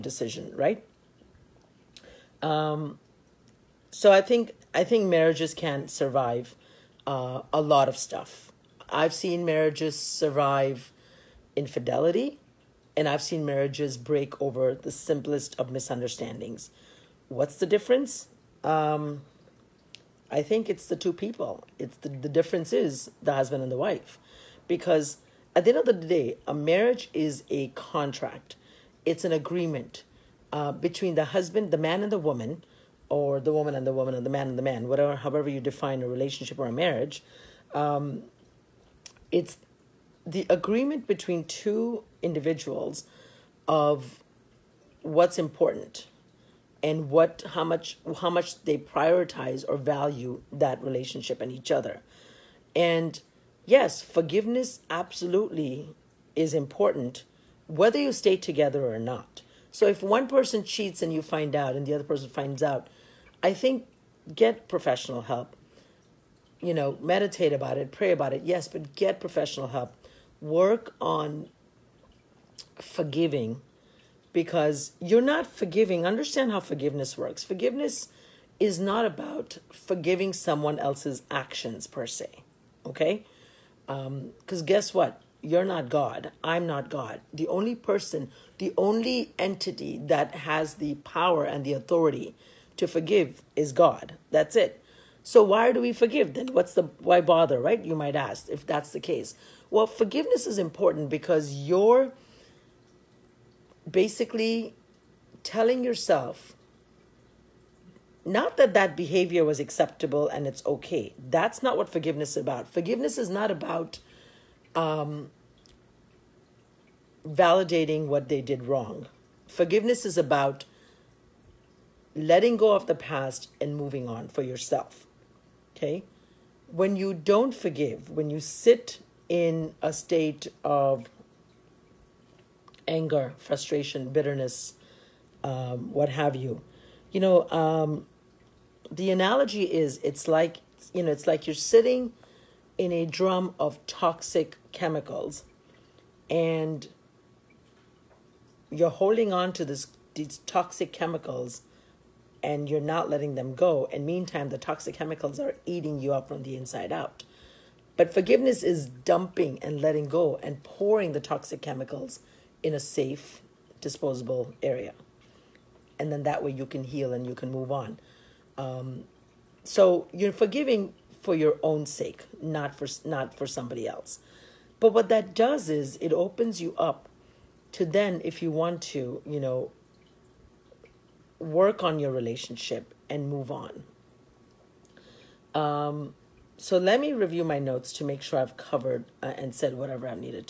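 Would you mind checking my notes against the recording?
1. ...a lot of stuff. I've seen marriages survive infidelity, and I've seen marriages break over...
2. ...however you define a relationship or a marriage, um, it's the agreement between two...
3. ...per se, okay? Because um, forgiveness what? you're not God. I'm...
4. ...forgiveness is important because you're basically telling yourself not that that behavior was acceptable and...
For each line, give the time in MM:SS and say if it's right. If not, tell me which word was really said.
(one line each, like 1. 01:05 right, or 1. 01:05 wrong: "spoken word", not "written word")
1. 00:07 right
2. 00:35 right
3. 01:21 wrong: "guess", not "forgiveness"
4. 01:39 right.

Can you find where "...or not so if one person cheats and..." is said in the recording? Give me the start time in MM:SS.
00:58.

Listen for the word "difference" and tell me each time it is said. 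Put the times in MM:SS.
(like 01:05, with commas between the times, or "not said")
00:17, 00:22.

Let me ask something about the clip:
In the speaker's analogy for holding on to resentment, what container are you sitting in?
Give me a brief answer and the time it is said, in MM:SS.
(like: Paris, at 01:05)
a drum of toxic chemicals, at 02:23.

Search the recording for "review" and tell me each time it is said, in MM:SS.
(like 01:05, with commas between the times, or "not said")
03:07.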